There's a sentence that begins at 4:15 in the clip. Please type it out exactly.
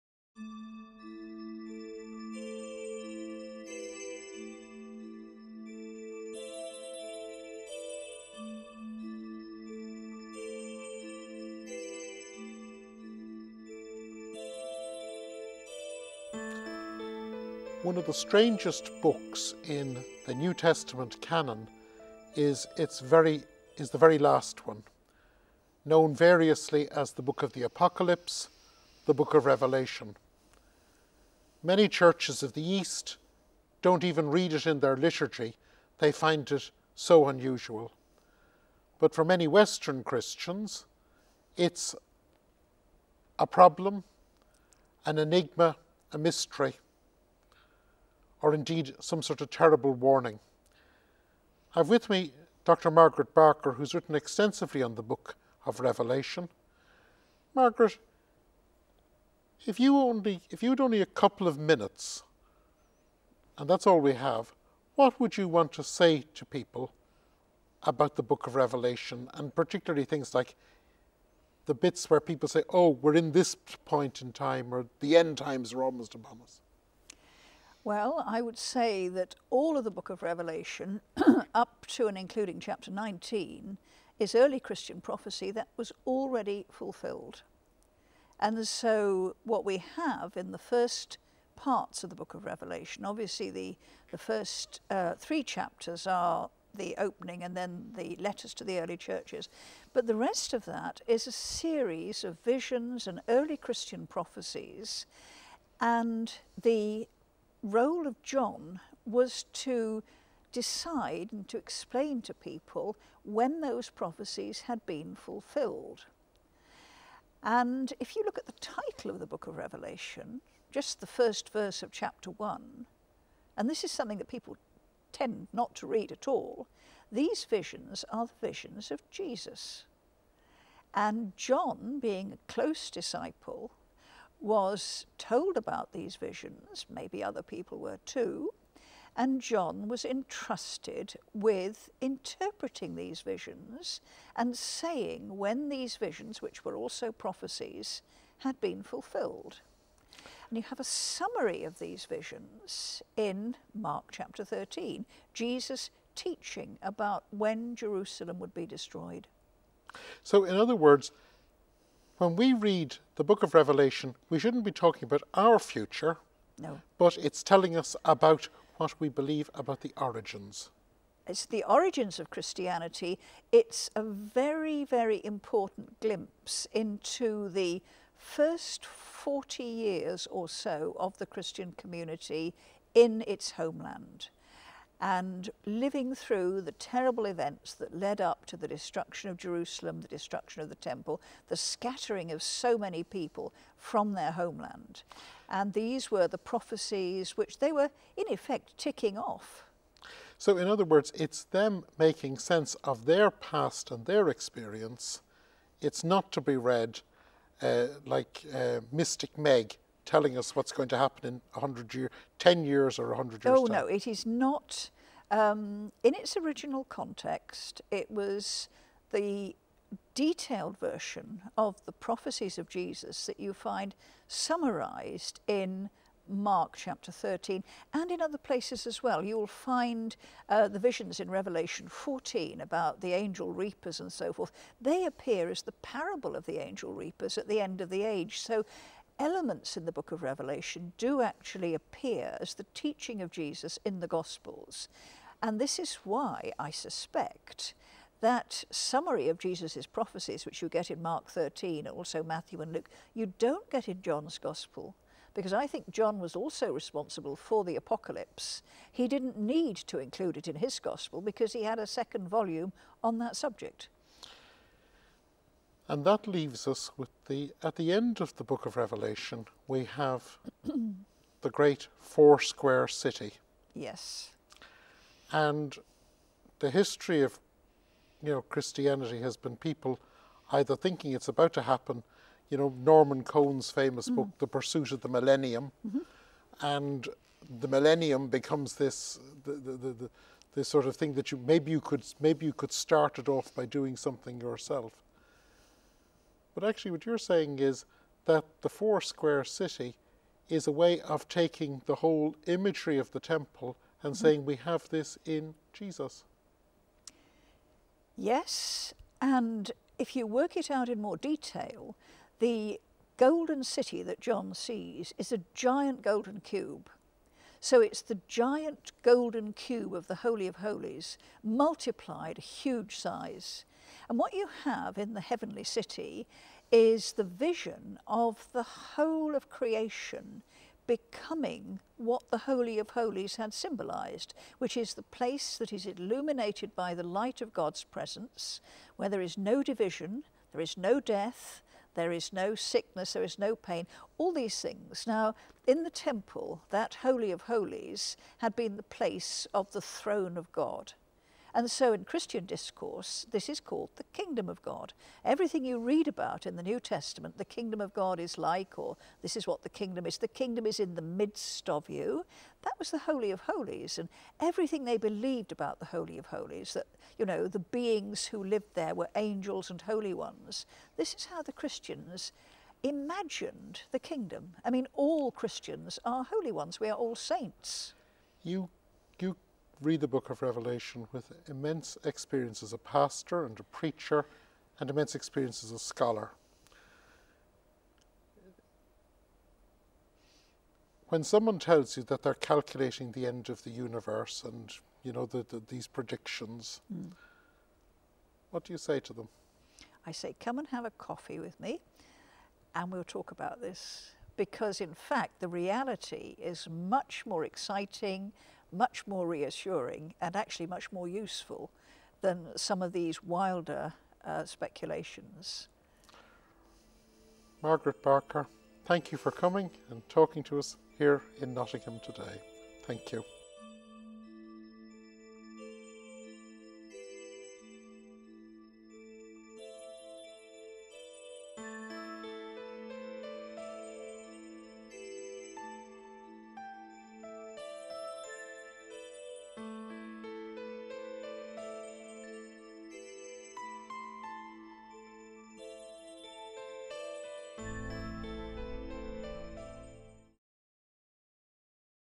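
Because I think John was also responsible for the apocalypse.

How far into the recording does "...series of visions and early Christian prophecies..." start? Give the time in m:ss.
1:41.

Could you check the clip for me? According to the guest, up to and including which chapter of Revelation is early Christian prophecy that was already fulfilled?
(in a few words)
Chapter 19.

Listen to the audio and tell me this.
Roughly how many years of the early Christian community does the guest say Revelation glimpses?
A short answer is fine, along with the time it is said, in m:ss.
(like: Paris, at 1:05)
40, at 2:58.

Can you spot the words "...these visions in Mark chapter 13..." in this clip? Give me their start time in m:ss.
2:31.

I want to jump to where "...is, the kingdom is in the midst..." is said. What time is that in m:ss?
6:00.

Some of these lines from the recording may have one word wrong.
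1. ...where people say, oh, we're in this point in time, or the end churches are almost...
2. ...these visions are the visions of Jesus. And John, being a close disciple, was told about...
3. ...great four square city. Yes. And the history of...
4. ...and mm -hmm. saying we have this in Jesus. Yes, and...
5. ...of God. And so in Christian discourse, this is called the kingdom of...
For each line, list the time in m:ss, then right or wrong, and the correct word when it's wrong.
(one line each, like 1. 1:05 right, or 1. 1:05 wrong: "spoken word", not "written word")
1. 1:12 wrong: "times", not "churches"
2. 2:07 right
3. 4:31 right
4. 5:04 right
5. 5:50 right.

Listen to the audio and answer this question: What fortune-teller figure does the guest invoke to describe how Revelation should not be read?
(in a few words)
Mystic Meg.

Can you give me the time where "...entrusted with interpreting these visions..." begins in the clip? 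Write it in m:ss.
2:20.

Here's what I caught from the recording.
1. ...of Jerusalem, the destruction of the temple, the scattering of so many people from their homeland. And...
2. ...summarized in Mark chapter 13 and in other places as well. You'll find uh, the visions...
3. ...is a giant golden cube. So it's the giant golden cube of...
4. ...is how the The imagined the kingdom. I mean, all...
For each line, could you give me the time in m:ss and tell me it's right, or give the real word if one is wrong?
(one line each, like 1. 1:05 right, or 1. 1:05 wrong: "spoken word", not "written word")
1. 3:09 right
2. 3:44 right
3. 5:15 right
4. 6:11 wrong: "Christians", not "The".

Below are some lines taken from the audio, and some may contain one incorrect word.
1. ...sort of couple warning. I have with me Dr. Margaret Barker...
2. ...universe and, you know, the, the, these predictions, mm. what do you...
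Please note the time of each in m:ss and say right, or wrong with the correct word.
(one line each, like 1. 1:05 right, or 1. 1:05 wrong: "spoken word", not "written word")
1. 0:49 wrong: "terrible", not "couple"
2. 6:33 right.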